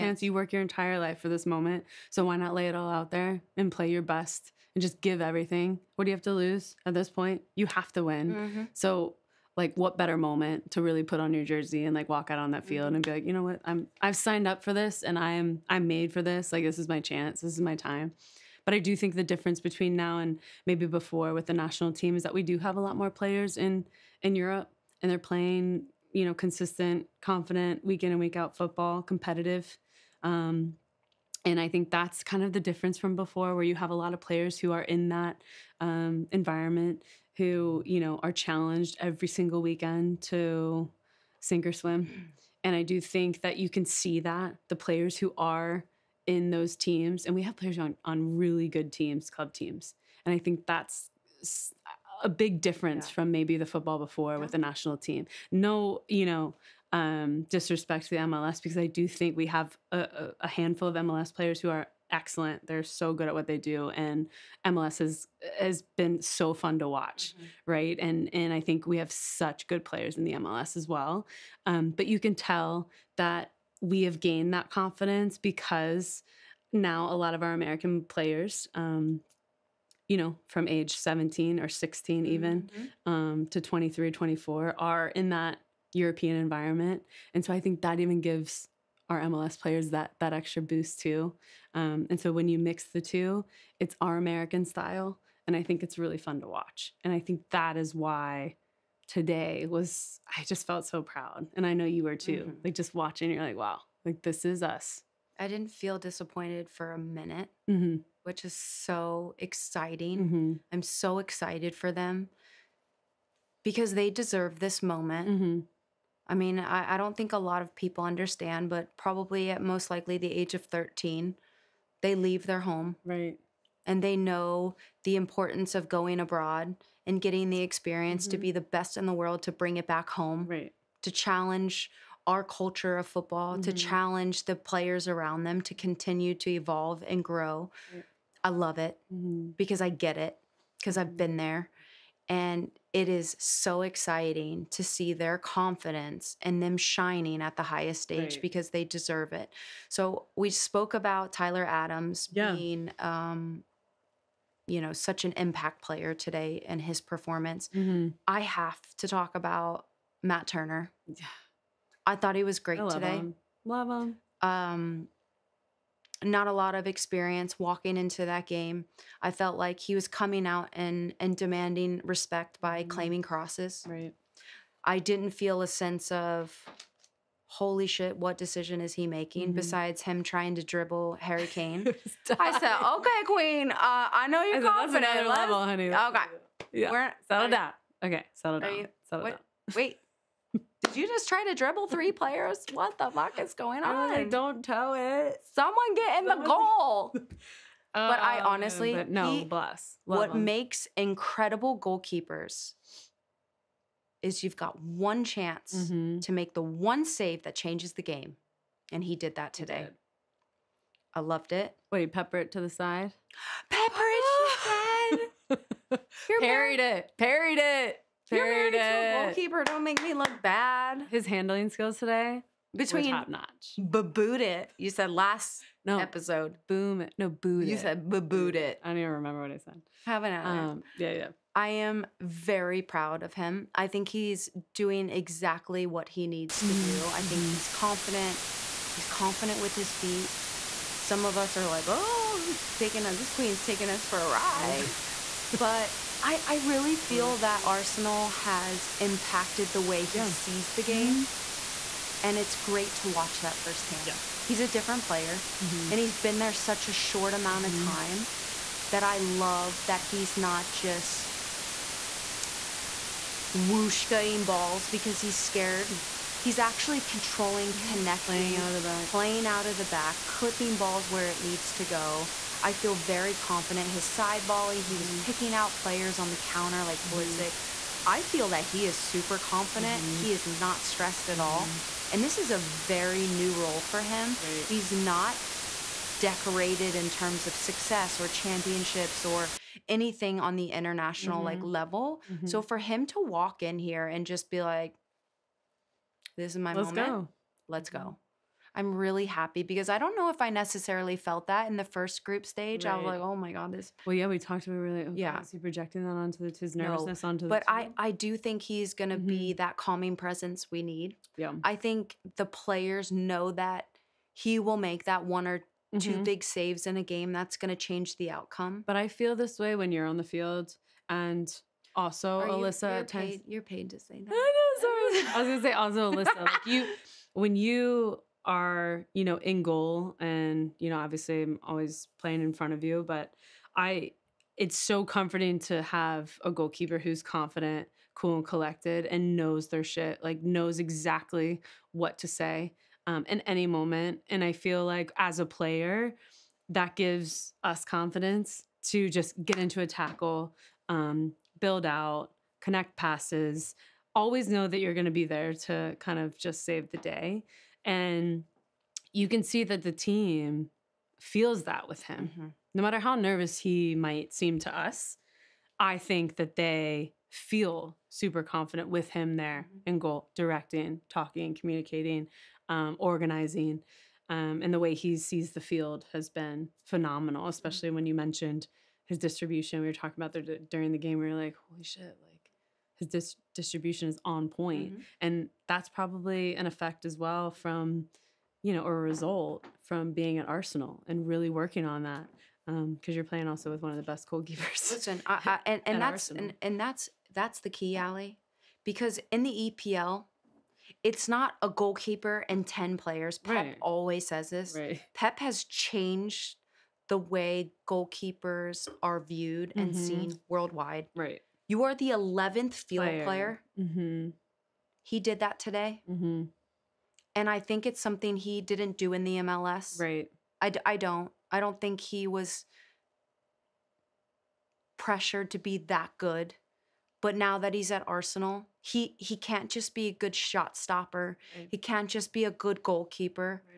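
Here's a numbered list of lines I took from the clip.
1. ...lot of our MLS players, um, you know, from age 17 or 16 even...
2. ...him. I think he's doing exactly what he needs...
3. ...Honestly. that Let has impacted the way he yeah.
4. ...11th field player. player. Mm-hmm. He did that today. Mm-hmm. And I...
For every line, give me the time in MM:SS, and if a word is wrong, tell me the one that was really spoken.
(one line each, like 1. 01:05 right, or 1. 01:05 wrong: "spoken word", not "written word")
1. 01:17 wrong: "American", not "MLS"
2. 03:53 right
3. 04:07 wrong: "Arsenal", not "Let"
4. 06:52 right.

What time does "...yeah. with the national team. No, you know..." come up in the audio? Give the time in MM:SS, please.
00:54.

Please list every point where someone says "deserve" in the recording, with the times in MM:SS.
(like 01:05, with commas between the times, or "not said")
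01:54, 02:28.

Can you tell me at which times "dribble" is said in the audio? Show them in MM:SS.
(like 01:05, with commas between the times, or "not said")
03:00, 03:11.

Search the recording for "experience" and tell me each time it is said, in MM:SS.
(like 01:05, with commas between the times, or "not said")
02:07, 02:46.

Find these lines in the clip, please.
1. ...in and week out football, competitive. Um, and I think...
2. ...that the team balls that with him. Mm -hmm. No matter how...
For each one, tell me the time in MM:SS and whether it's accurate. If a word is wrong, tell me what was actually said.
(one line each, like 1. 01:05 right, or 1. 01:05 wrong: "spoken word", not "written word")
1. 00:28 right
2. 05:59 wrong: "feels", not "balls".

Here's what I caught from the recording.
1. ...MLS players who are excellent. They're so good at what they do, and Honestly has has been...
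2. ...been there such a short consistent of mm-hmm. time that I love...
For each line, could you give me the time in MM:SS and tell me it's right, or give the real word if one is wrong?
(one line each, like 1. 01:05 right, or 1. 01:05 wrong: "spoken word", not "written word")
1. 01:00 wrong: "MLS", not "Honestly"
2. 04:16 wrong: "amount", not "consistent".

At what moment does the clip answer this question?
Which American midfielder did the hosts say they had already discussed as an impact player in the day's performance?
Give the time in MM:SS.
02:31.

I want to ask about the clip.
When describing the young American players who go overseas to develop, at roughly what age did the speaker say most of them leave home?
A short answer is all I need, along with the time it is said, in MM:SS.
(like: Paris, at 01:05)
13, at 02:00.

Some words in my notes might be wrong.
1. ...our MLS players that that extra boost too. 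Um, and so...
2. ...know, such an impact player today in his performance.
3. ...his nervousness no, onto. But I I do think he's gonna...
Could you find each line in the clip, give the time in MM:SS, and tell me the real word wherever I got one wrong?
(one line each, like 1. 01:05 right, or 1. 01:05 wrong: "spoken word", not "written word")
1. 01:29 right
2. 02:34 right
3. 05:06 right.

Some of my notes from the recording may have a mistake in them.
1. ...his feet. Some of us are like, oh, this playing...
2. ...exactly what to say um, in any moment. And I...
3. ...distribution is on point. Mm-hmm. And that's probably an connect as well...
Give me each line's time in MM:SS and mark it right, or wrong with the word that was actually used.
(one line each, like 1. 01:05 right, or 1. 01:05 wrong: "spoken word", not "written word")
1. 03:59 wrong: "taking", not "playing"
2. 05:40 right
3. 06:23 wrong: "effect", not "connect".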